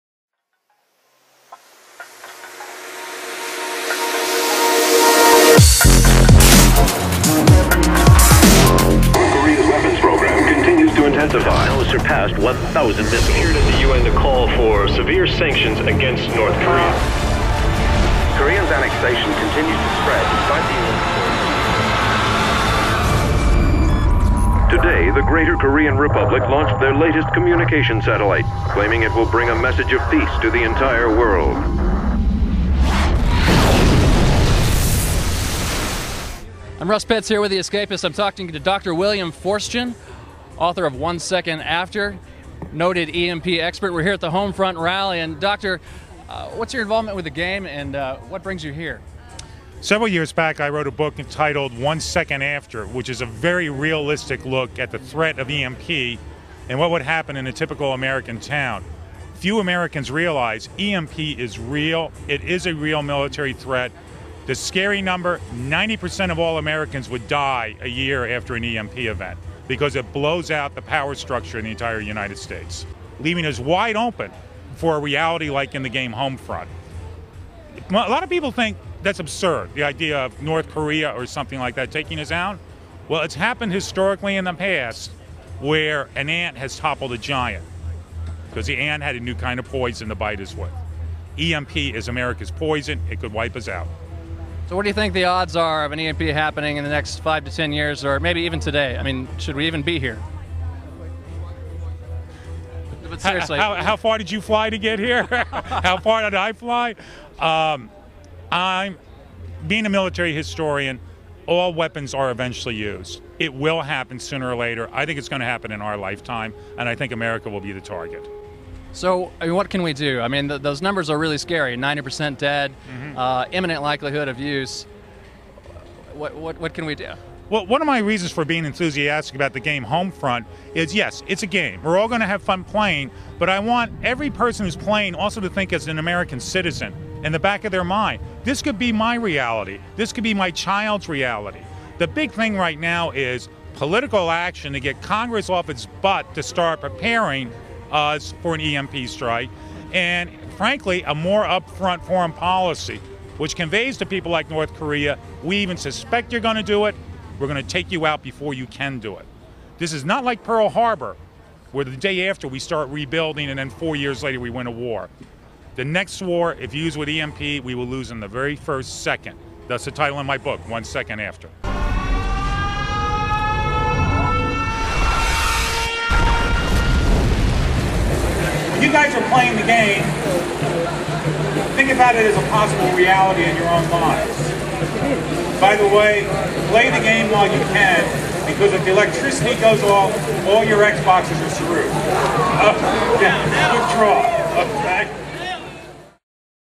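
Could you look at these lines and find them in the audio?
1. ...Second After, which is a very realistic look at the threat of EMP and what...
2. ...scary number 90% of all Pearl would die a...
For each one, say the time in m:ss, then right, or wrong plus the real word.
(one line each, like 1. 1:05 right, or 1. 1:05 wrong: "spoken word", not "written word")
1. 0:51 right
2. 1:04 wrong: "Americans", not "Pearl".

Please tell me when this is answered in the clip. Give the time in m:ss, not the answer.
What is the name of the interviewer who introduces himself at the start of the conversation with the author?
0:36.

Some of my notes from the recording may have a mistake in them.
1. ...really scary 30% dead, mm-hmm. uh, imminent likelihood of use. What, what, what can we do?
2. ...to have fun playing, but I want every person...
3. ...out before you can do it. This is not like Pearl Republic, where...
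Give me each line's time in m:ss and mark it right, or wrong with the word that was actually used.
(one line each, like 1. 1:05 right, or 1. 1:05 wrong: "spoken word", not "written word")
1. 2:01 wrong: "90", not "30"
2. 2:12 right
3. 2:38 wrong: "Harbor", not "Republic".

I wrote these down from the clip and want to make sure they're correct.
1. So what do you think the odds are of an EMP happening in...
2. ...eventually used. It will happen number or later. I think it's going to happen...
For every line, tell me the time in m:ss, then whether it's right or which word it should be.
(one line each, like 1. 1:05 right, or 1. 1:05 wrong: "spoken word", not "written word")
1. 1:34 right
2. 1:52 wrong: "sooner", not "number".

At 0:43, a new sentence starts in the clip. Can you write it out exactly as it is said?
We're here at the Homefront Rally.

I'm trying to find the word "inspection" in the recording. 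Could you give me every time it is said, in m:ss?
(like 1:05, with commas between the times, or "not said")
not said.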